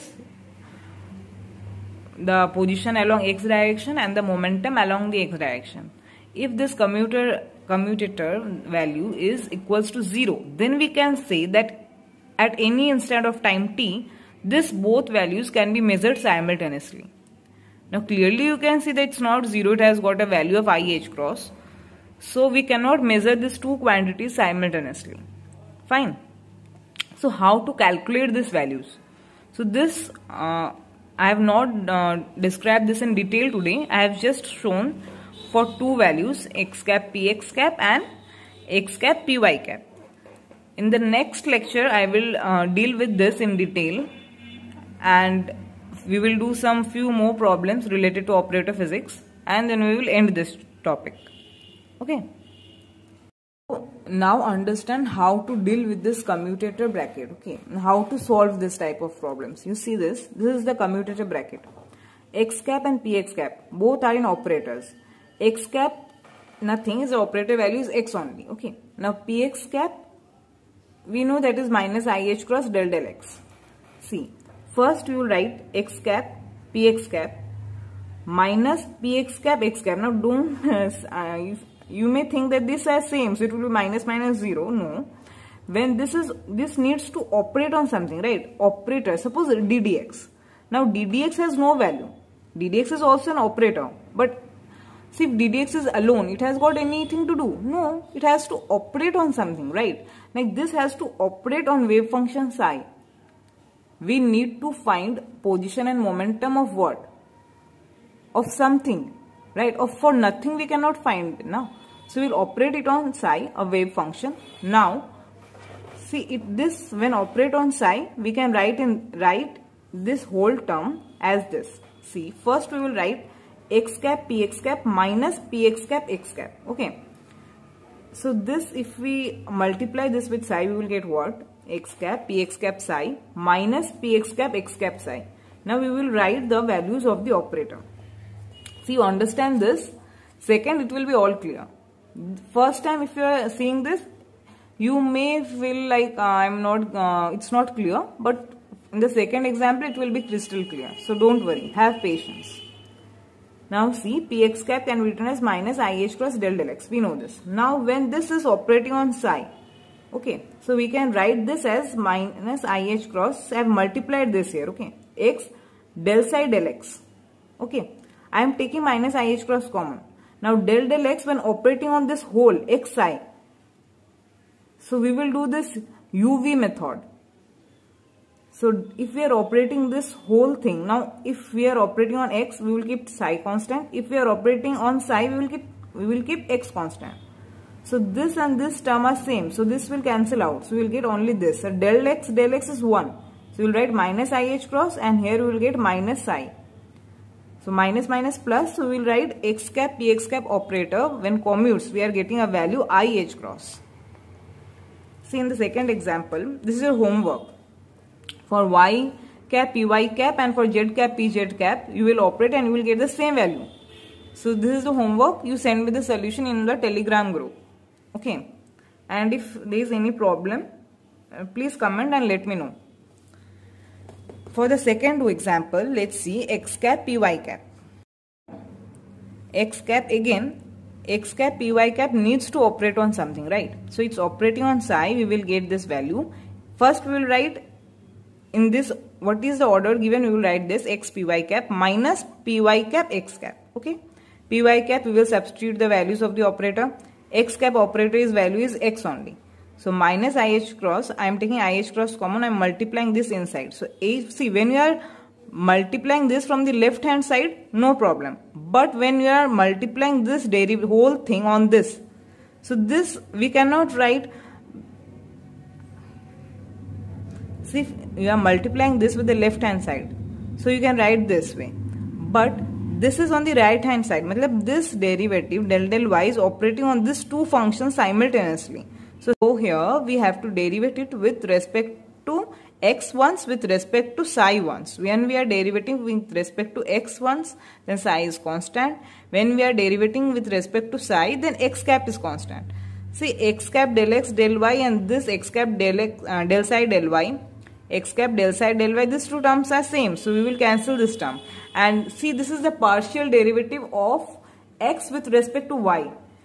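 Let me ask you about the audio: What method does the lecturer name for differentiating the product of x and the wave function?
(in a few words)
uv method.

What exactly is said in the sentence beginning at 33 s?
I have just shown for two values x cap px cap and x cap py cap.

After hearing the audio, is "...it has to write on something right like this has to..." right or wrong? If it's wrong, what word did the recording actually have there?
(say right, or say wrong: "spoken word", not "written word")
wrong: "operate", not "write".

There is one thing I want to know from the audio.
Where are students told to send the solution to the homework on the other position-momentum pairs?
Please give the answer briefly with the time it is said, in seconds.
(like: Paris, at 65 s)
Telegram group, at 216 s.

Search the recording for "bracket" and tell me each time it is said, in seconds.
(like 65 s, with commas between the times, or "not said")
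56 s, 61 s.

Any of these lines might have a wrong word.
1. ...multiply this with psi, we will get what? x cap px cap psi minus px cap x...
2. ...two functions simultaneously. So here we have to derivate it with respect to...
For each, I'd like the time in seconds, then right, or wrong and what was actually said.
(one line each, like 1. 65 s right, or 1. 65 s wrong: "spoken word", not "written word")
1. 129 s right
2. 277 s right.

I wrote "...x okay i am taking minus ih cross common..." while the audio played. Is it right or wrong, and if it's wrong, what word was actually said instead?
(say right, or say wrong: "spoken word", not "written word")
right.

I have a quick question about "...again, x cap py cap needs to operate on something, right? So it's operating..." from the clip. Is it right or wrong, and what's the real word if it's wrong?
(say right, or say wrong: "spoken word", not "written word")
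right.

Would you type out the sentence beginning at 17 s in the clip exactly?
Now clearly you can see that it's not 0, it has got a value of ih cross.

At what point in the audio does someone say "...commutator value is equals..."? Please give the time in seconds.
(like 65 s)
7 s.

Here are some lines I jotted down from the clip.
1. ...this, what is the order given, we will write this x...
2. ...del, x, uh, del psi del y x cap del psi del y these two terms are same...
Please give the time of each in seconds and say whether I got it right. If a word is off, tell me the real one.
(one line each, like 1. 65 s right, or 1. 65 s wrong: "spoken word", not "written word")
1. 238 s right
2. 295 s right.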